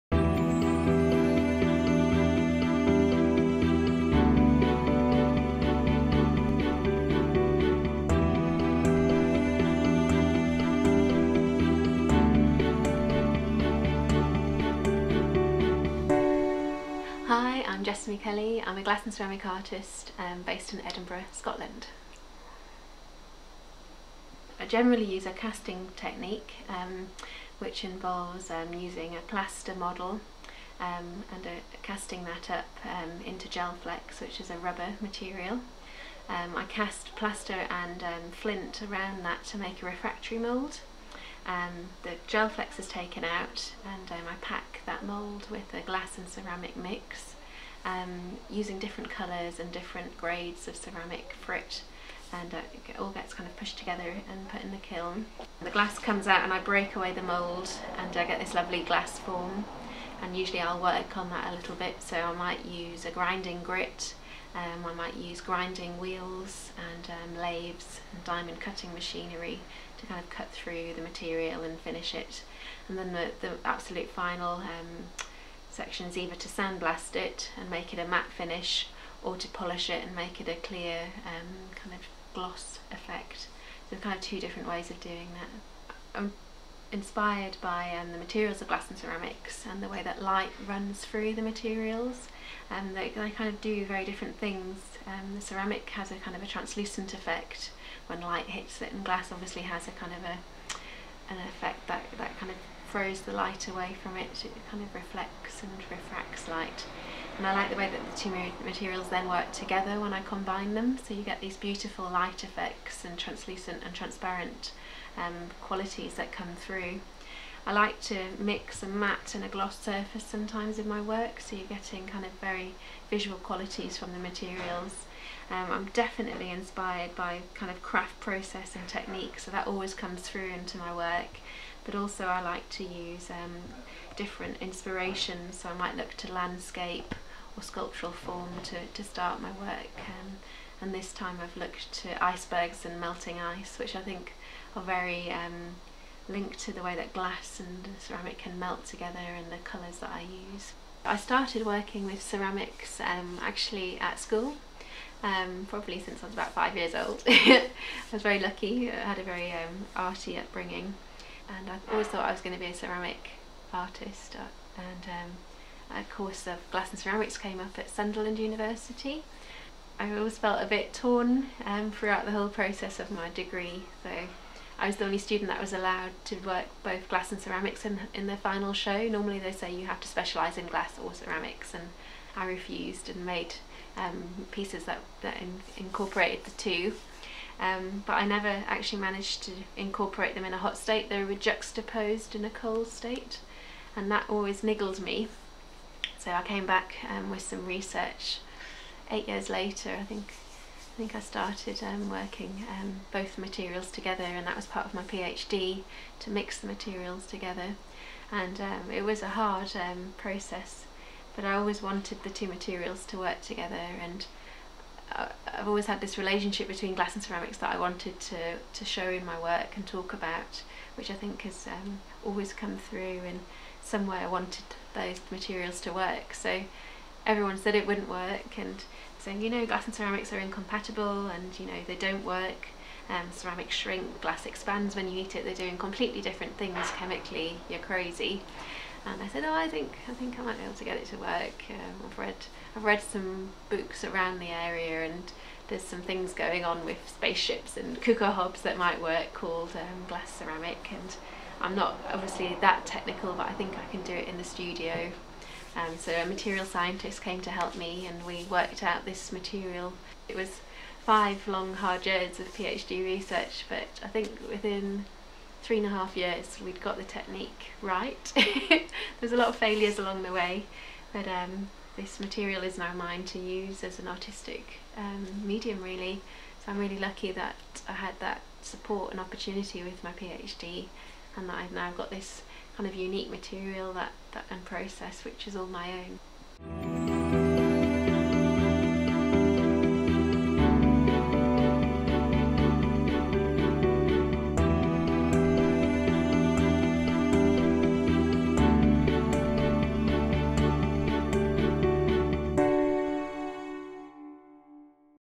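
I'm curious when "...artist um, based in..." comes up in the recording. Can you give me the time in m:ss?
0:19.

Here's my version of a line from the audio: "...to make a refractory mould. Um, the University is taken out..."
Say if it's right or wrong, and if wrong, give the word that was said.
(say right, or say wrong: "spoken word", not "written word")
wrong: "Gelflex", not "University".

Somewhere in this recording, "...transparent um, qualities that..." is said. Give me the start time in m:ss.
1:53.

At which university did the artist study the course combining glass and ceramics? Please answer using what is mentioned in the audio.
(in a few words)
Sunderland University.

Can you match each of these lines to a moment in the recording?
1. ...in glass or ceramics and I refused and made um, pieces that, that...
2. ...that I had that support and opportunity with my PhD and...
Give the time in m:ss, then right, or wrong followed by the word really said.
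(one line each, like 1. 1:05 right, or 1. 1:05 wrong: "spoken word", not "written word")
1. 3:00 right
2. 4:37 right.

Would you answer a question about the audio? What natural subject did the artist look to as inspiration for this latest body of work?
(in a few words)
Icebergs and melting ice.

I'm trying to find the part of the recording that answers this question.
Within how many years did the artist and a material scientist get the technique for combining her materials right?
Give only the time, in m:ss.
4:25.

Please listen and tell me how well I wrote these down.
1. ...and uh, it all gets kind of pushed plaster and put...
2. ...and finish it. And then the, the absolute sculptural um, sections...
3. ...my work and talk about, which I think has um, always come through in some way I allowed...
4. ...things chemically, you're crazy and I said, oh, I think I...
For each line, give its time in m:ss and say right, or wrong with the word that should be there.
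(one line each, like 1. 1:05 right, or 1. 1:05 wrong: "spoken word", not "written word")
1. 0:52 wrong: "together", not "plaster"
2. 1:11 wrong: "final", not "sculptural"
3. 3:39 wrong: "wanted", not "allowed"
4. 3:56 right.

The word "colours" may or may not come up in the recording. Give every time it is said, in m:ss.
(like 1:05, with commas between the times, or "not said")
0:49, 2:29.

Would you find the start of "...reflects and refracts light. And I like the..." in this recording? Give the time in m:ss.
1:44.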